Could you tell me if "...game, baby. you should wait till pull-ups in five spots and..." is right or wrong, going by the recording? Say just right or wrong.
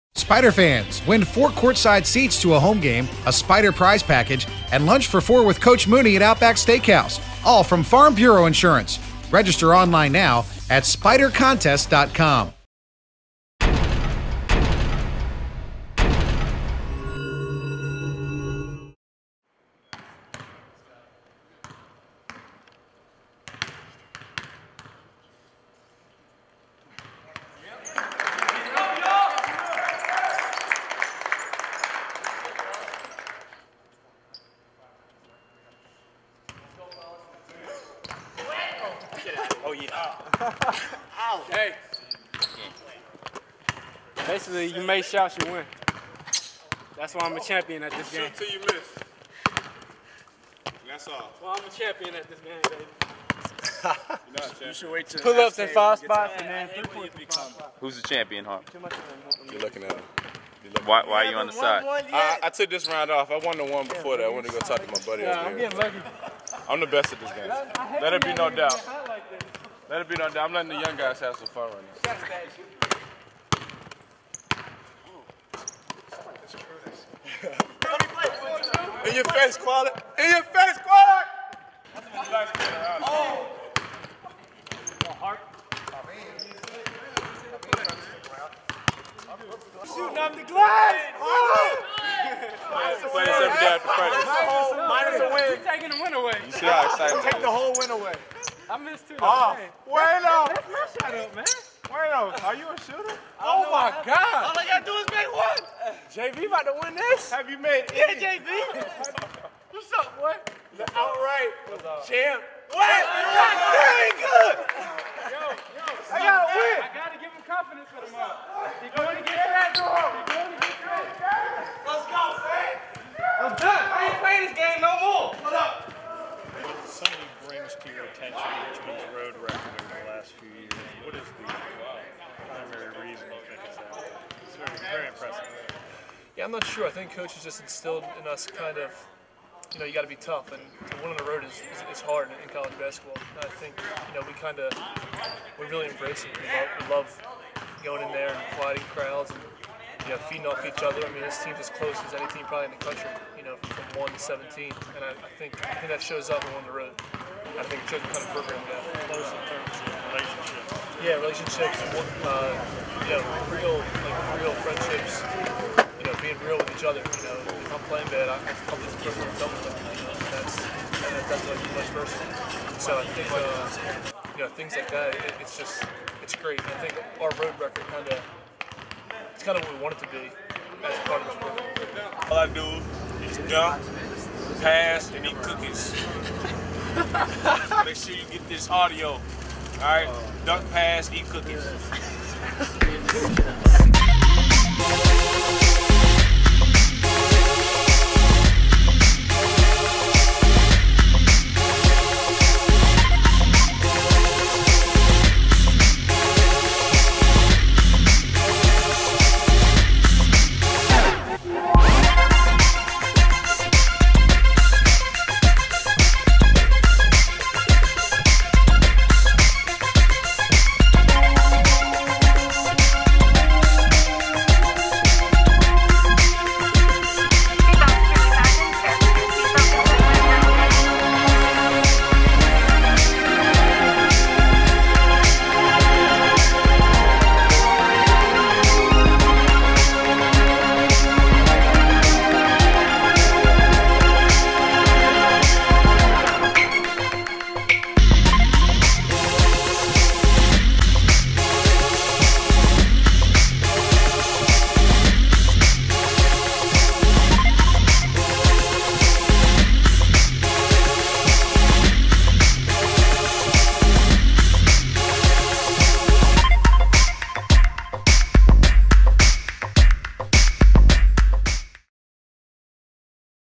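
right.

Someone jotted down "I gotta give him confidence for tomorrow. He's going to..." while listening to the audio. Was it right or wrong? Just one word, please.
right.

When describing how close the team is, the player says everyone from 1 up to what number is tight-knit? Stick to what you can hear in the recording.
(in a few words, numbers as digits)
17.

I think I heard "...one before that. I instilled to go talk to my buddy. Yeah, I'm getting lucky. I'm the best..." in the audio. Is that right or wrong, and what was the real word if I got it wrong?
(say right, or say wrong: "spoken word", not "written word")
wrong: "wanted", not "instilled".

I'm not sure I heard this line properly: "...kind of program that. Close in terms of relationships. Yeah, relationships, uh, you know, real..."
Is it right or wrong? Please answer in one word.
right.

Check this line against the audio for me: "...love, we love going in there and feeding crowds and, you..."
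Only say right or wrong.
wrong.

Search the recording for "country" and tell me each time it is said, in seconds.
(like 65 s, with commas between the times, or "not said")
152 s.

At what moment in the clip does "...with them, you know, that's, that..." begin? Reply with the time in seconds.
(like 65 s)
169 s.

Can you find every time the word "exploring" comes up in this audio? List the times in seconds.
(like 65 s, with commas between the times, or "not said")
not said.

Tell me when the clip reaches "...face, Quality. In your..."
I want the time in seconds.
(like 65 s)
79 s.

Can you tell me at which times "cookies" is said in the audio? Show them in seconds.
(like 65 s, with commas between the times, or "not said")
185 s, 191 s.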